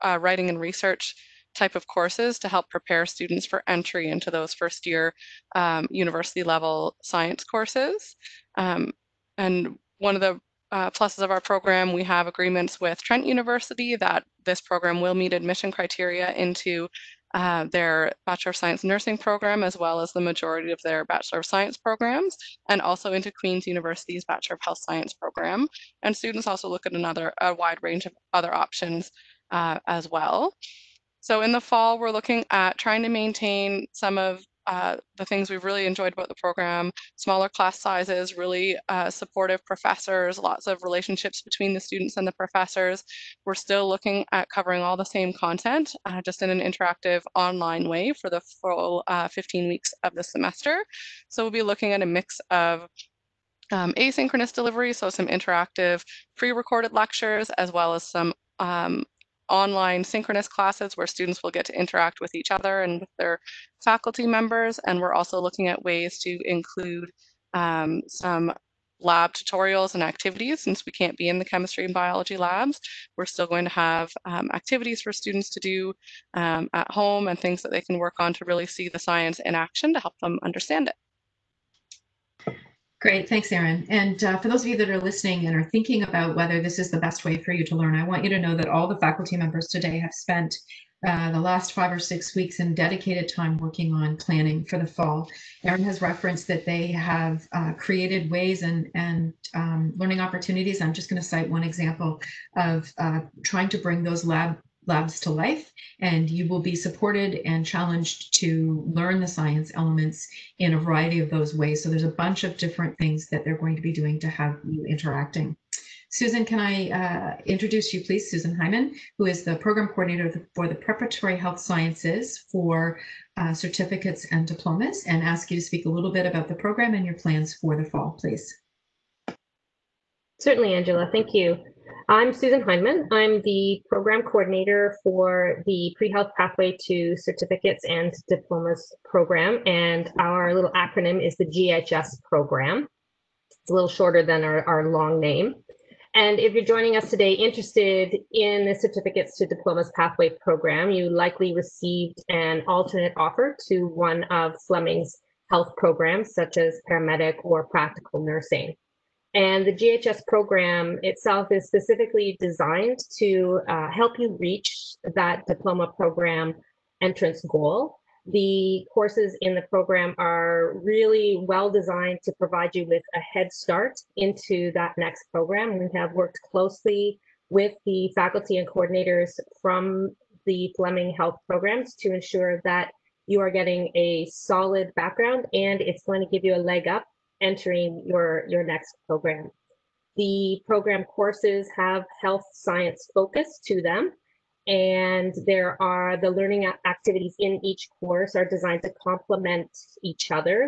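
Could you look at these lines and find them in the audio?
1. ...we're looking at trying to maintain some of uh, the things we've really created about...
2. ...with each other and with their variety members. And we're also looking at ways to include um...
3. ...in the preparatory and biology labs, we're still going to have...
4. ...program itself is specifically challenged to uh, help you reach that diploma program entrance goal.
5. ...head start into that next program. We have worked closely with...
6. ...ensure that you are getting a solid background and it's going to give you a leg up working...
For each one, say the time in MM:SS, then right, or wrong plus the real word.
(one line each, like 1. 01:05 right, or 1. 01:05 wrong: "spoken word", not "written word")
1. 00:31 wrong: "enjoyed", not "created"
2. 01:02 wrong: "faculty", not "variety"
3. 01:11 wrong: "chemistry", not "preparatory"
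4. 02:40 wrong: "designed", not "challenged"
5. 02:53 right
6. 03:02 wrong: "entering", not "working".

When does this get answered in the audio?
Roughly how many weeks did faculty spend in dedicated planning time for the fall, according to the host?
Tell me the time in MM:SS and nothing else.
01:31.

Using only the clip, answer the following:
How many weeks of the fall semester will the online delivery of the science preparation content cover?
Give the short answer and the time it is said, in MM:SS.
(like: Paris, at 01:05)
15, at 00:49.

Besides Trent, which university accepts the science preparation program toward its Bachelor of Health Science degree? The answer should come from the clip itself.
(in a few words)
Queen's University.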